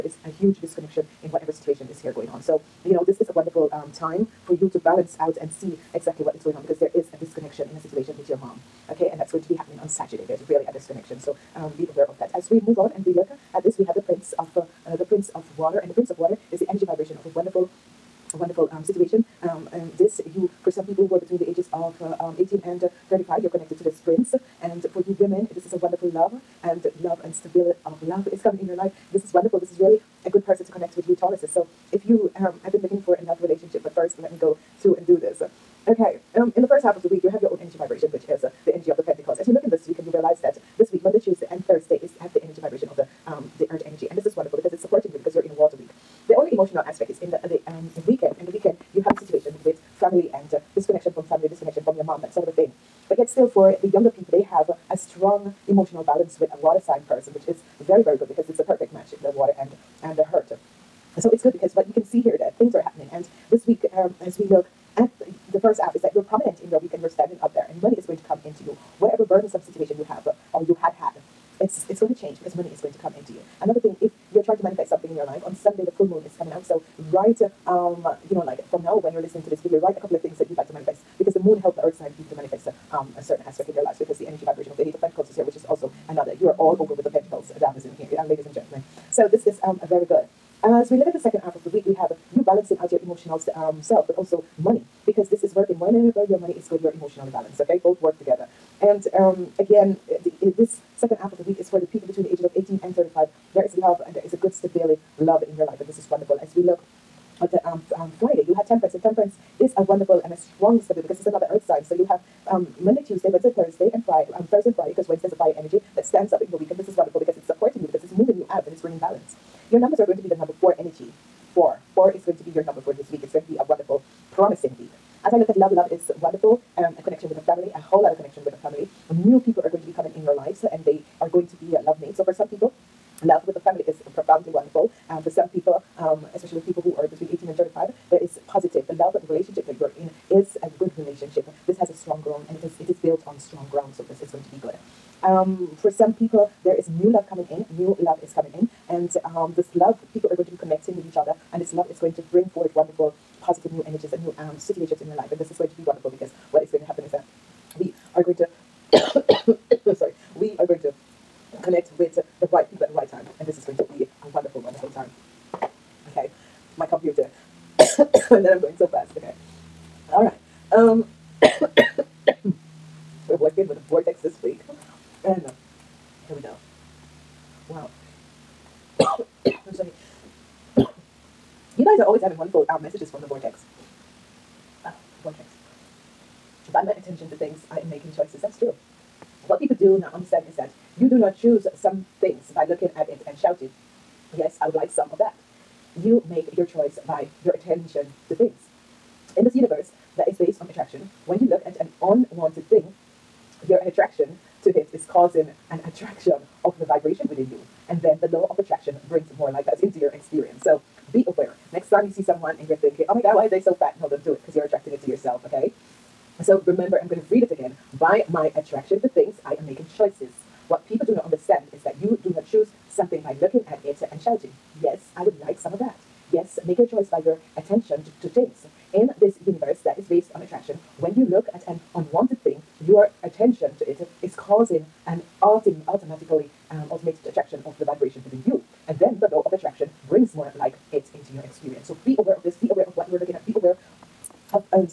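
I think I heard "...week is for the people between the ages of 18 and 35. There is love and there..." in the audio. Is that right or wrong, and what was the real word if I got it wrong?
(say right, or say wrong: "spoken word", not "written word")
right.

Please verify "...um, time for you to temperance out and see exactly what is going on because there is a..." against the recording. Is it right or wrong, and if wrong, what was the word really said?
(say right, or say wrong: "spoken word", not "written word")
wrong: "balance", not "temperance".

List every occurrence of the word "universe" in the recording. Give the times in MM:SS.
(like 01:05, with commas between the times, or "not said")
03:19, 03:49.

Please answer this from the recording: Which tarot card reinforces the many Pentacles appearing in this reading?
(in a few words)
Eight of Pentacles.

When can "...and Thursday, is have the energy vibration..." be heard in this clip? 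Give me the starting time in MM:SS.
00:41.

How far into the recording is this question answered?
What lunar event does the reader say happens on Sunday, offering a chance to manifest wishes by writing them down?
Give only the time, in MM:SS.
01:15.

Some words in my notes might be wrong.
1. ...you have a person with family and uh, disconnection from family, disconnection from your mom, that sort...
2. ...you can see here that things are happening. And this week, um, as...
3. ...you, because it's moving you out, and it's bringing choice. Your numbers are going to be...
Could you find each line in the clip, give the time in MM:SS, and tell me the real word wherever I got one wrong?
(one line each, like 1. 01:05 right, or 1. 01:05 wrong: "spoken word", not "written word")
1. 00:48 wrong: "situation", not "person"
2. 01:01 right
3. 01:57 wrong: "balance", not "choice".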